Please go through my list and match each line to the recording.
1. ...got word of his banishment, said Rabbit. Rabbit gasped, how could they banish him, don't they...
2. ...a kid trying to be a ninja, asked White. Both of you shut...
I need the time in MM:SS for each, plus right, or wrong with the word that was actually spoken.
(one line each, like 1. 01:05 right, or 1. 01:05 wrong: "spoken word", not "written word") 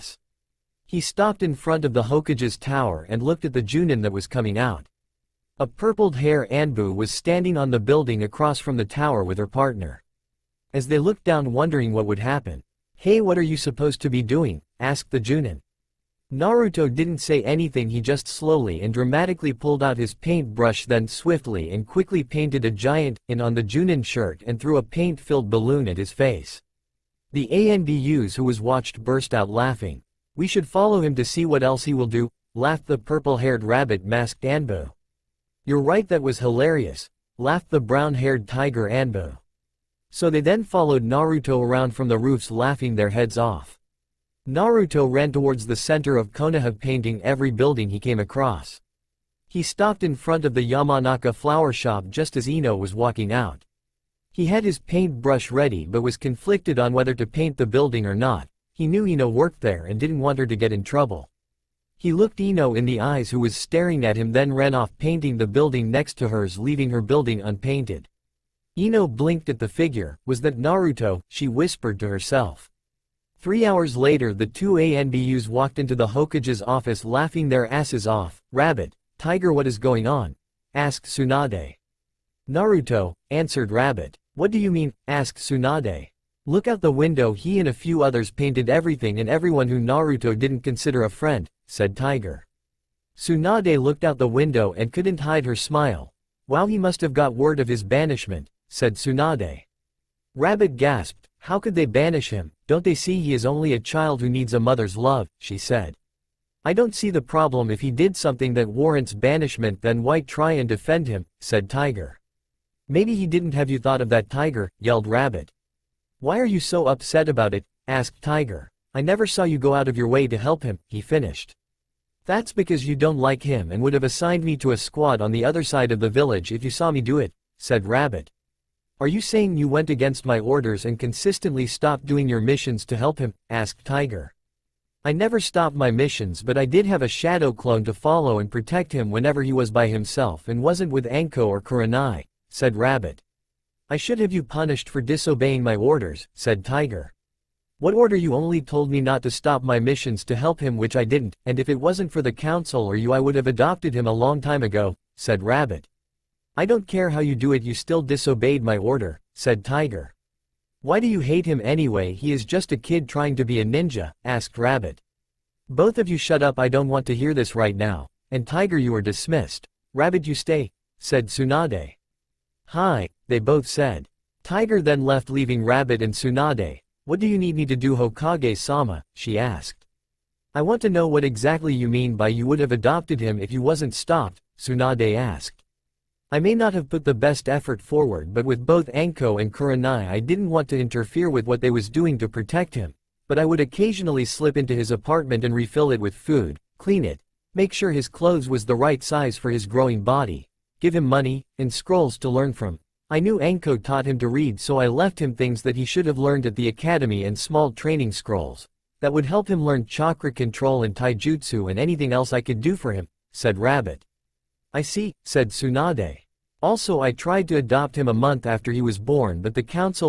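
1. 01:37 wrong: "Tsunade", not "Rabbit"
2. 02:42 wrong: "Rabbit", not "White".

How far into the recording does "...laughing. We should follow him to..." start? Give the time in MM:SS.
00:29.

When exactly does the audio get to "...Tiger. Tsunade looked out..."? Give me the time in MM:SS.
01:31.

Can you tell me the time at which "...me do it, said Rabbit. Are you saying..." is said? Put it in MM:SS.
02:06.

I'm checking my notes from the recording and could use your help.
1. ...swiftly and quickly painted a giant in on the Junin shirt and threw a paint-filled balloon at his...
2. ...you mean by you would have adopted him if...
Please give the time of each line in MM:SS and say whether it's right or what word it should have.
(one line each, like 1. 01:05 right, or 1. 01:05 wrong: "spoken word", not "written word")
1. 00:21 right
2. 03:01 right.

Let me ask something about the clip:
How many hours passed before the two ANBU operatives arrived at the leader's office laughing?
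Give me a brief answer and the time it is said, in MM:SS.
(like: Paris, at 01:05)
3, at 01:13.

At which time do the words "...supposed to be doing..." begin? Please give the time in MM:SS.
00:13.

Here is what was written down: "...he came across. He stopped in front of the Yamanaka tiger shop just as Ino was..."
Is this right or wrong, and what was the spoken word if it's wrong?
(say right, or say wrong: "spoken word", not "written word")
wrong: "flower", not "tiger".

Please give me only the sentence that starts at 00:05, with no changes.
A purpled haired Anbu was standing on the building across from the tower with her partner.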